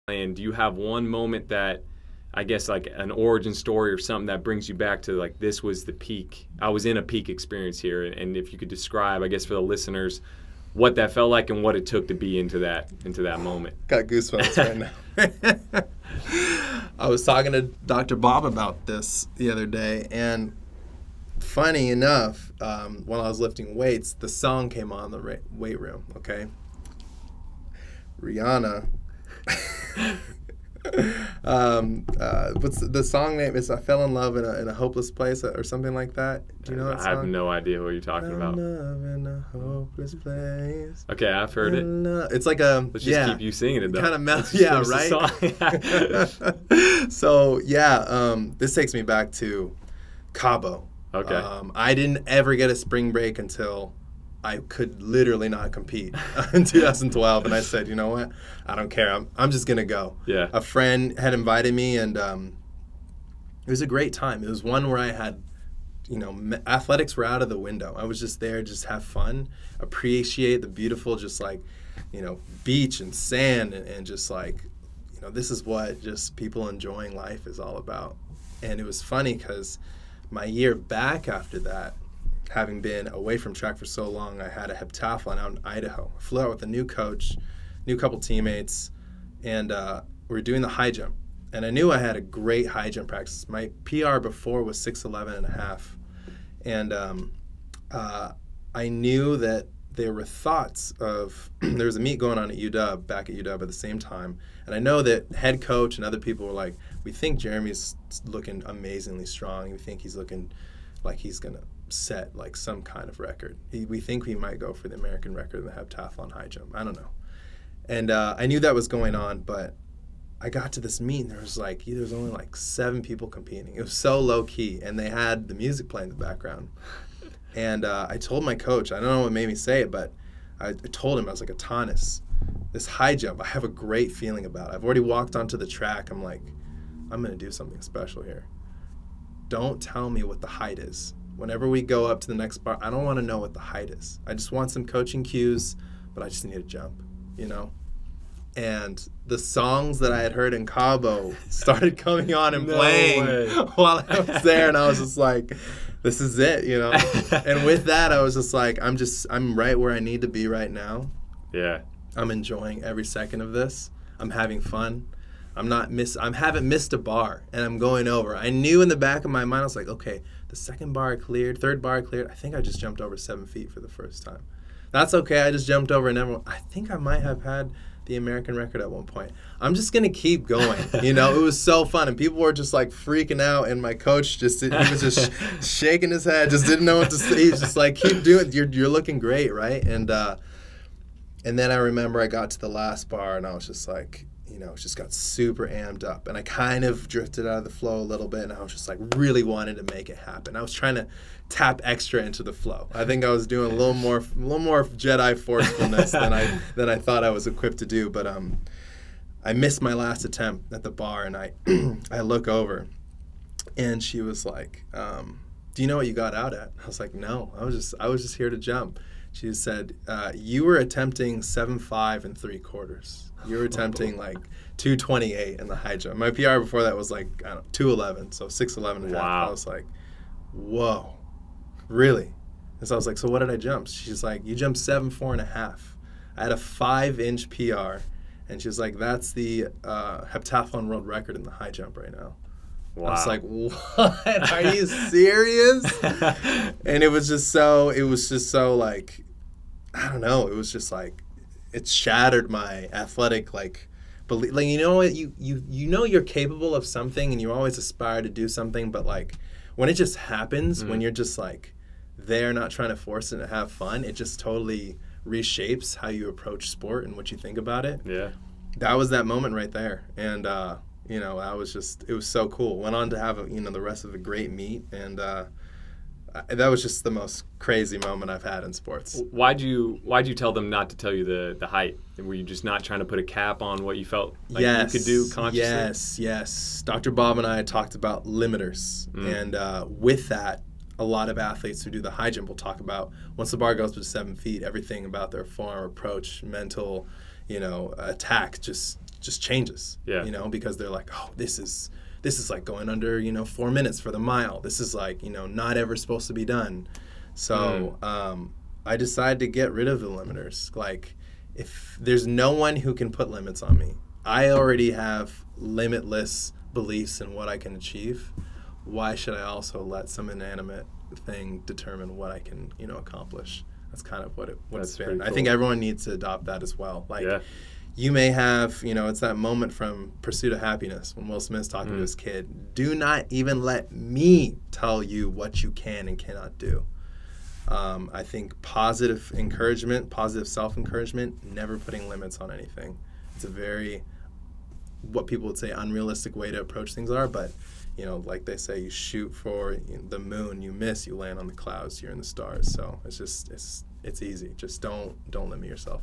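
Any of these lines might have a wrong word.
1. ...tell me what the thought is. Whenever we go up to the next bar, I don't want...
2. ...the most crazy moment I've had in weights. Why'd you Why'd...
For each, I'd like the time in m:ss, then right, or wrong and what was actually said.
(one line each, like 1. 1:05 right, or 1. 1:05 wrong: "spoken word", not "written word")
1. 2:19 wrong: "height", not "thought"
2. 4:37 wrong: "sports", not "weights".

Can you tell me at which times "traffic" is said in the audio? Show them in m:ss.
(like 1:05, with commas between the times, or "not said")
not said.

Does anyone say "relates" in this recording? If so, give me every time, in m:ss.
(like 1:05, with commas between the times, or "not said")
not said.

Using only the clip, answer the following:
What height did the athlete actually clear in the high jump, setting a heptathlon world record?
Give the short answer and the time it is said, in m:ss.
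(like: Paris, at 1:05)
7'4.5", at 3:54.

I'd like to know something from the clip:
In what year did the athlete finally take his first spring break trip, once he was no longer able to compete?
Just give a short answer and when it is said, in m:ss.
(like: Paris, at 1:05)
2012, at 0:56.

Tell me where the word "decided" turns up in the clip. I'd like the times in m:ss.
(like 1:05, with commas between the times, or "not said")
5:08.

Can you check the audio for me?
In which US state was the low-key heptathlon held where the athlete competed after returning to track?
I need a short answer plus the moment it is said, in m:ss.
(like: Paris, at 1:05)
Idaho, at 1:25.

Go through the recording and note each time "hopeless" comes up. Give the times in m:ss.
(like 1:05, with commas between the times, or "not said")
0:34, 0:39.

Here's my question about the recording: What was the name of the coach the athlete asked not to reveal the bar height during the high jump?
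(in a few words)
Atanas.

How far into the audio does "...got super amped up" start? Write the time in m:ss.
3:14.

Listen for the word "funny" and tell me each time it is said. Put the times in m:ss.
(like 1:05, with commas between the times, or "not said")
0:21, 1:19.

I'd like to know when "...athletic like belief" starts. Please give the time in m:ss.
4:12.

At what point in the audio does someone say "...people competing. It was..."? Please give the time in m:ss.
2:03.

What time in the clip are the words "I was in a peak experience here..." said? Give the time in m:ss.
0:06.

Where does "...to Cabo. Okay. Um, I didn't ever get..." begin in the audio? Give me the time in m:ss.
0:49.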